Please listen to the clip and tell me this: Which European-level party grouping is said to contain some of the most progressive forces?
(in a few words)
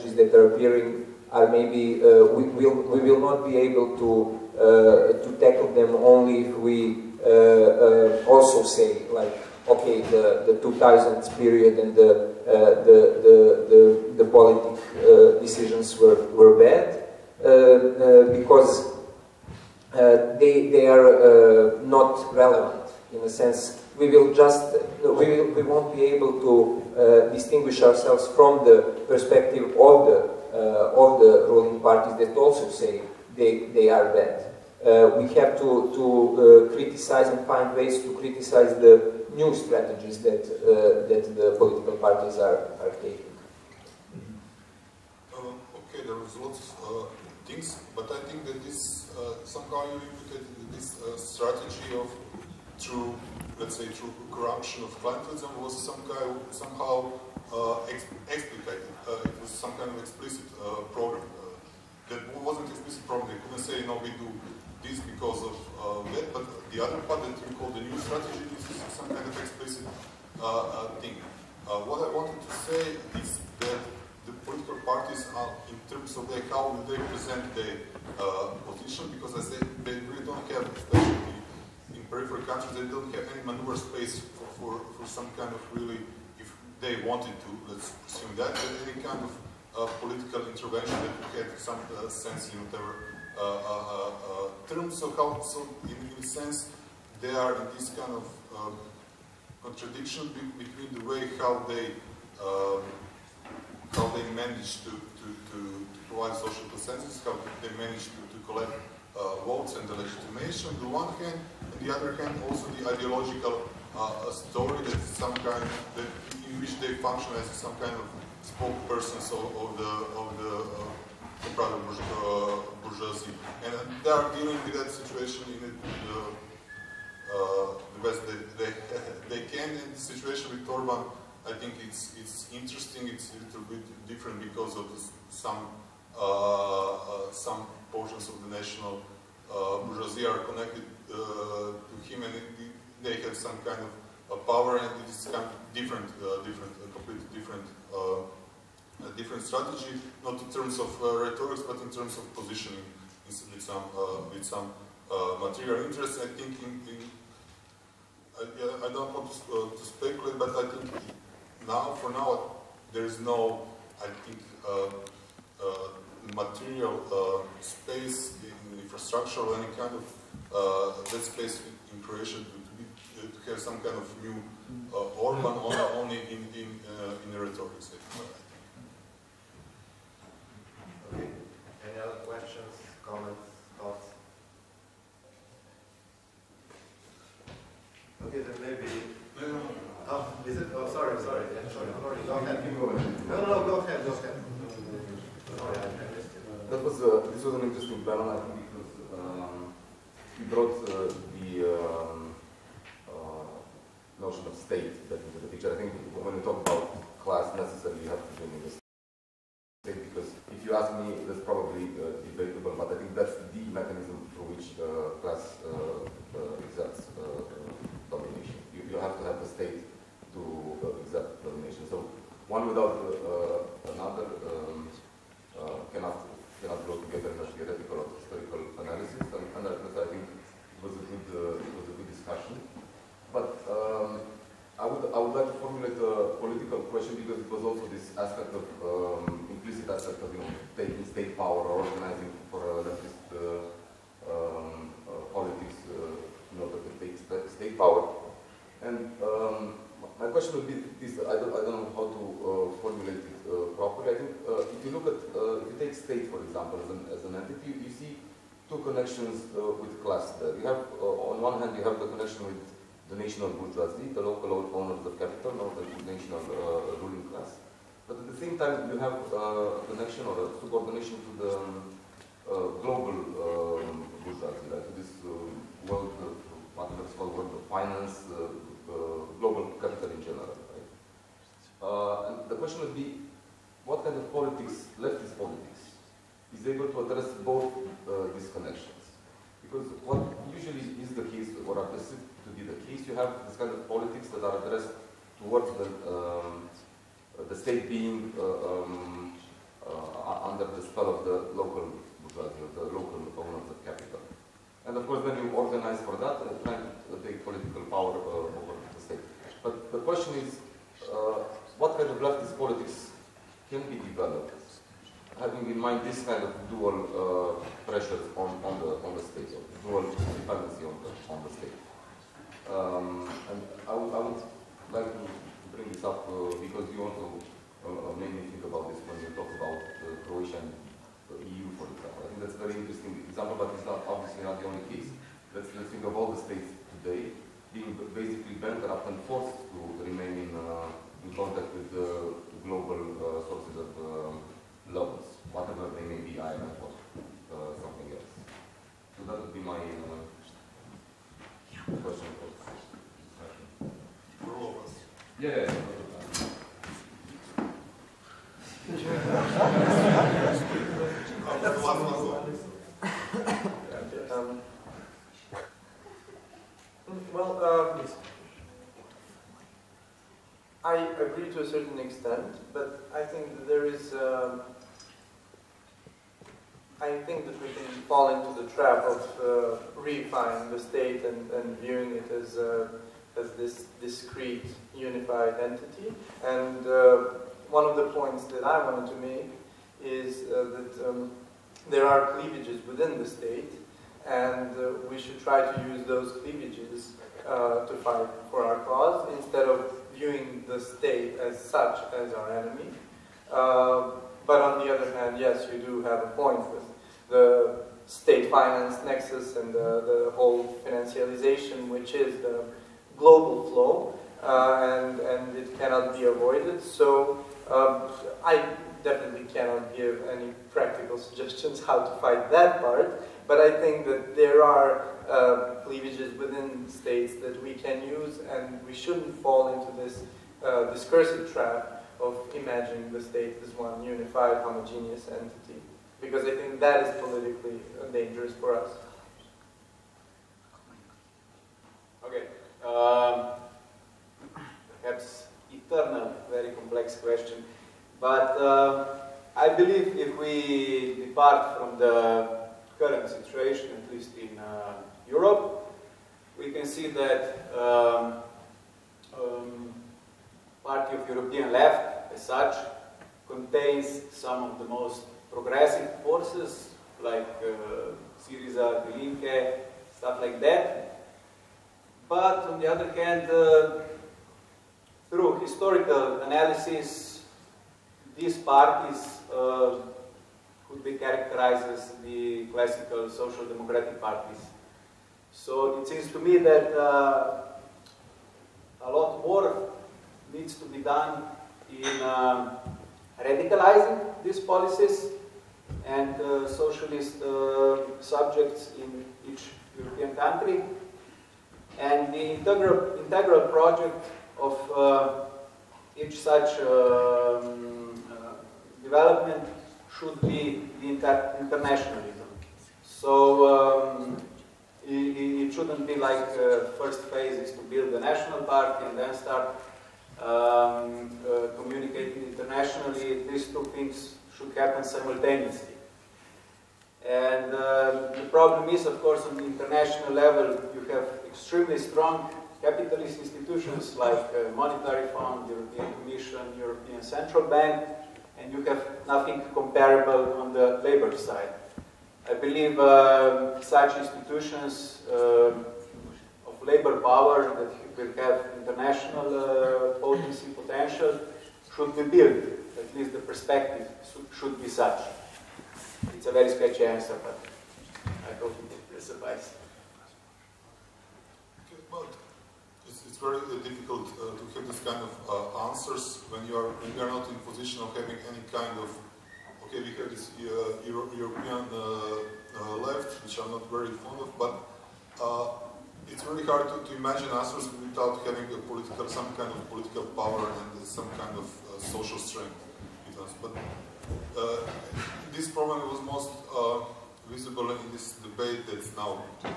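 Party of European Left.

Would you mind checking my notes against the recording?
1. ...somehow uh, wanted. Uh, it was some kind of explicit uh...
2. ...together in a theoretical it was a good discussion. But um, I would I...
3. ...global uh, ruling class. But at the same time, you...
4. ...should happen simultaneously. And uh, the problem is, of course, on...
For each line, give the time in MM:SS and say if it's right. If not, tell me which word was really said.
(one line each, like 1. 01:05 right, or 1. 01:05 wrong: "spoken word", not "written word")
1. 00:56 wrong: "explicated", not "wanted"
2. 03:47 right
3. 04:26 wrong: "national", not "global"
4. 08:44 right.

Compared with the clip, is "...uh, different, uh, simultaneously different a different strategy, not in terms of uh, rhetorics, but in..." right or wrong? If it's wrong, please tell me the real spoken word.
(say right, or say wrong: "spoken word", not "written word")
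wrong: "completely", not "simultaneously".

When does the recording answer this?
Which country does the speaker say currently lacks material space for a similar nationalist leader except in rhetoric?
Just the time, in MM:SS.
02:52.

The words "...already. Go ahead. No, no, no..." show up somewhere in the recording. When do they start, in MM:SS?
03:12.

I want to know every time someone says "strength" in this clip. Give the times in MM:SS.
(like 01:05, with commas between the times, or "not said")
09:42.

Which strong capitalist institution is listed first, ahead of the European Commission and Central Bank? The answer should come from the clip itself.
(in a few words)
Monetary Fund.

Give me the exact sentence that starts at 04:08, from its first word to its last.
And um, my question would be this: I don't I don't know how to uh, formulate it uh, properly.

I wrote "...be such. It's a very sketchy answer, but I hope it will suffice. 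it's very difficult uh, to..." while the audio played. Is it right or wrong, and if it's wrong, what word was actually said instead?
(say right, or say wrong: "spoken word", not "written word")
right.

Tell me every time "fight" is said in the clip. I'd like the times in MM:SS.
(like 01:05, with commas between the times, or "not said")
06:38, 07:02.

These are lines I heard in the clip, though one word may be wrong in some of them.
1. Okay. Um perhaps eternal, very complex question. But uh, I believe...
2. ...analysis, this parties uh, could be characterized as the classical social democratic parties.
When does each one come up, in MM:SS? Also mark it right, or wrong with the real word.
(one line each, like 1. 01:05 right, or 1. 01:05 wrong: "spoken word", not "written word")
1. 07:22 right
2. 07:56 right.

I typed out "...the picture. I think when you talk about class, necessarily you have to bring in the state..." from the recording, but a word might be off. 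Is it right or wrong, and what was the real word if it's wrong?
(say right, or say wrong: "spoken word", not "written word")
right.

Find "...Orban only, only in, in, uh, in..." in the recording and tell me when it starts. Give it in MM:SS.
02:55.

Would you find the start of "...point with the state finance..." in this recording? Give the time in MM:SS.
06:46.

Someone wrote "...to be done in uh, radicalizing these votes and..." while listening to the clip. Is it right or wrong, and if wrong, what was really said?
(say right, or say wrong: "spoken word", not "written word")
wrong: "policies", not "votes".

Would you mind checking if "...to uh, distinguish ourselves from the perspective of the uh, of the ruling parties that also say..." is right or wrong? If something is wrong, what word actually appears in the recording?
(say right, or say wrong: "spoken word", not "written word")
right.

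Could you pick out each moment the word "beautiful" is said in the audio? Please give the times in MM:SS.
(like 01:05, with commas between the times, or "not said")
not said.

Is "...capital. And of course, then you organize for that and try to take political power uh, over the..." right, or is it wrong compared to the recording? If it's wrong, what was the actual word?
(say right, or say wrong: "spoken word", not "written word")
right.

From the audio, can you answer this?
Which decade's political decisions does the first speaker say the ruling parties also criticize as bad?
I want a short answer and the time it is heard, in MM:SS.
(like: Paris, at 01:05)
2000s, at 00:10.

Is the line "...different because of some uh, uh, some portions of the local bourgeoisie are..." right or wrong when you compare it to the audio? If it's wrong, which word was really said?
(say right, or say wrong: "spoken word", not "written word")
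wrong: "national", not "local".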